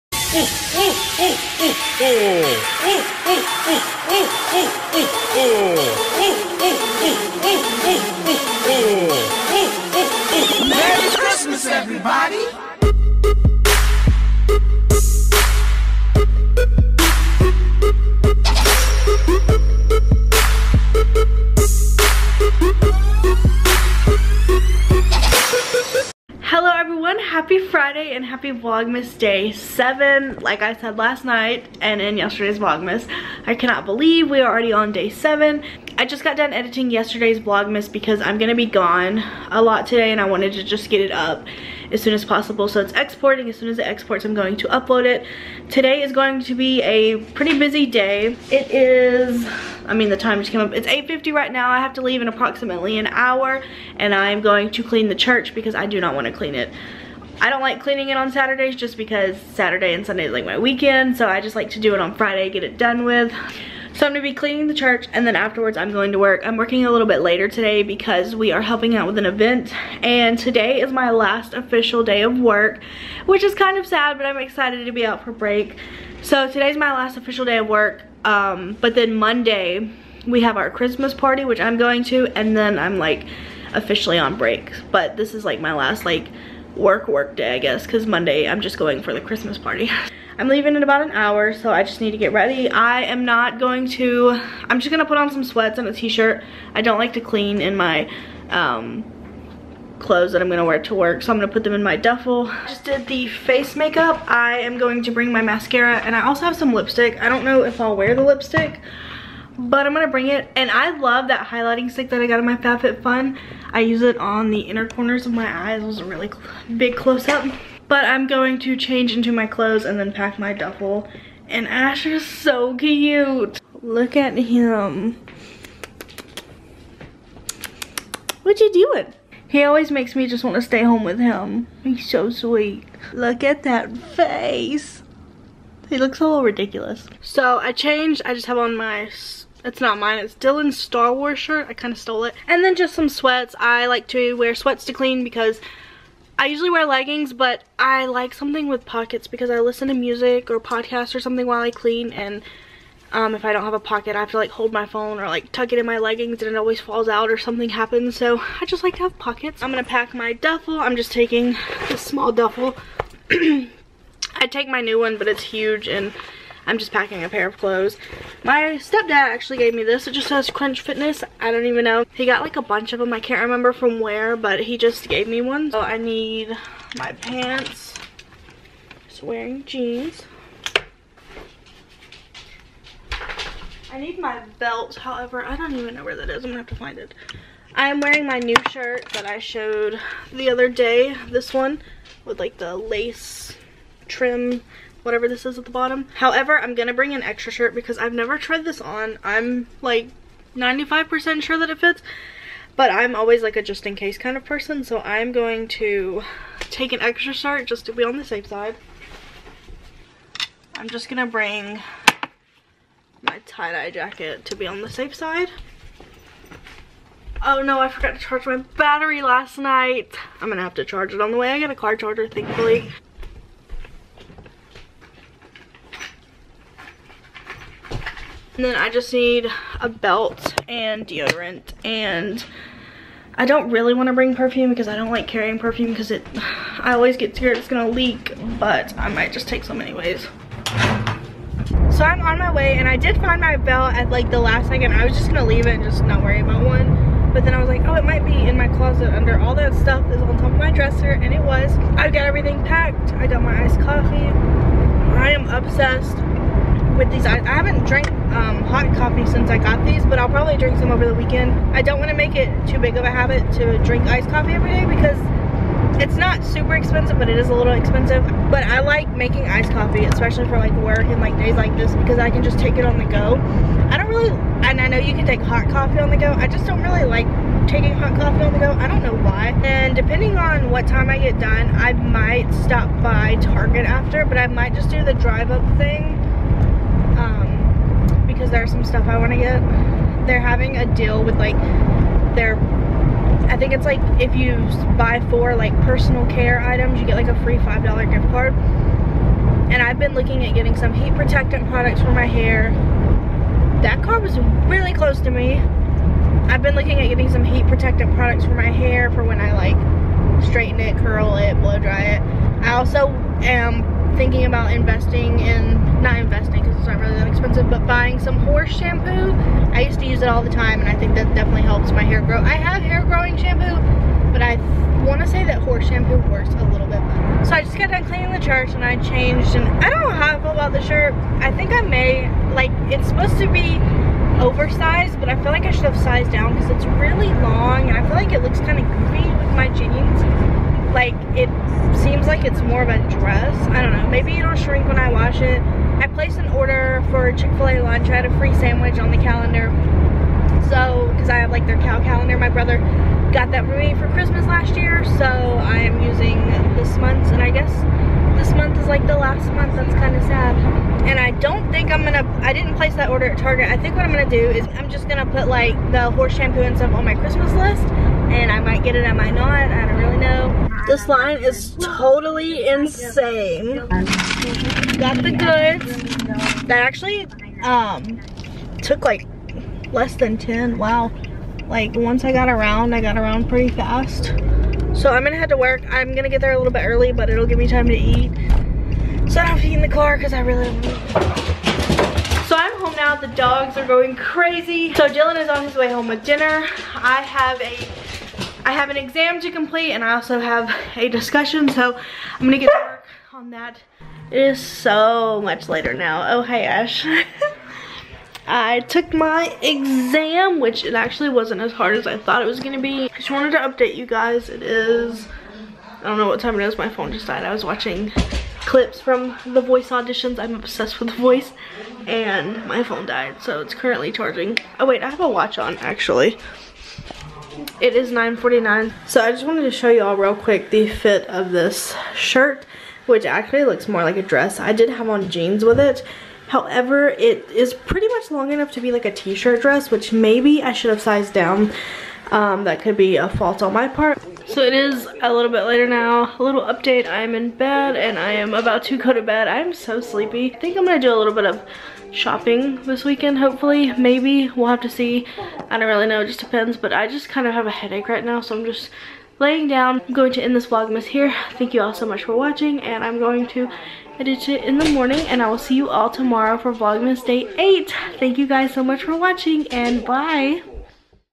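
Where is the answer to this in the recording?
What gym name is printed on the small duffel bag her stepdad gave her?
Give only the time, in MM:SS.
02:50.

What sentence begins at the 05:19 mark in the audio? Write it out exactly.
I used to use it all the time and I think that definitely helps my hair grow.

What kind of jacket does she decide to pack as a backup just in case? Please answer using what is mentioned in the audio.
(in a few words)
Tie-dye jacket.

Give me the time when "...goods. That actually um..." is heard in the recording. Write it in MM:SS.
06:15.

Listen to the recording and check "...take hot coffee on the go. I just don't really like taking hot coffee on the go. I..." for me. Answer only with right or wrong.
right.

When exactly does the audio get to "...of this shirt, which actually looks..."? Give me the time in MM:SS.
07:11.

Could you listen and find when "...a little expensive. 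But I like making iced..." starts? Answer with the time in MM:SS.
04:27.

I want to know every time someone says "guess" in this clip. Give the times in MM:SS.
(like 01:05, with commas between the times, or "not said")
01:27, 05:57.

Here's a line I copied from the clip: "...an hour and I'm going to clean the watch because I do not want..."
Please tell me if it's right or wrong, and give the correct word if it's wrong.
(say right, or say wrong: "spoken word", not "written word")
wrong: "church", not "watch".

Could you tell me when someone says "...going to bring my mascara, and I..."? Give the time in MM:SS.
01:44.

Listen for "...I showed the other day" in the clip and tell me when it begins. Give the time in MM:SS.
03:09.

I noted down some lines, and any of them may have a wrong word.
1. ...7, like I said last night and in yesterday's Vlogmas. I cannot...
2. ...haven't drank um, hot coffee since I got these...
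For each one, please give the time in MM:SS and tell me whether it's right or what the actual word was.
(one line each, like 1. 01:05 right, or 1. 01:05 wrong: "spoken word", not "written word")
1. 00:29 right
2. 04:17 right.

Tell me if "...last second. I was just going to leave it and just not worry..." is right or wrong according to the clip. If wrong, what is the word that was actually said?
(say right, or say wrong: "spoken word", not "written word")
right.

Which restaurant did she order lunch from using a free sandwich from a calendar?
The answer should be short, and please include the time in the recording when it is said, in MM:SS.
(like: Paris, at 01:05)
Chick-fil-A, at 05:47.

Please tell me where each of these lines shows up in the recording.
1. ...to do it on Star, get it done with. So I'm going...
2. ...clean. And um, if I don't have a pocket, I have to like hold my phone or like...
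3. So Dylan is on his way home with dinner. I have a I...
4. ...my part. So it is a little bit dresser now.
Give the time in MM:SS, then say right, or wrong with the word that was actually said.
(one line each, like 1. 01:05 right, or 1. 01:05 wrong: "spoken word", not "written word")
1. 01:01 wrong: "Friday", not "Star"
2. 02:31 right
3. 06:34 right
4. 07:23 wrong: "later", not "dresser".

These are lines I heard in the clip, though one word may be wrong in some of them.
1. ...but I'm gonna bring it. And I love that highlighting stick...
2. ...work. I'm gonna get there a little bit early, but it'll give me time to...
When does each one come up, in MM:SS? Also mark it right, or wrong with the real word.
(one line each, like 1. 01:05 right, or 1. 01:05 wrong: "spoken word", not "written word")
1. 01:49 right
2. 06:25 right.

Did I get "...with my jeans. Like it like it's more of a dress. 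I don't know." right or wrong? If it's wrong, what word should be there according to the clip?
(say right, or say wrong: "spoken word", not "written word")
right.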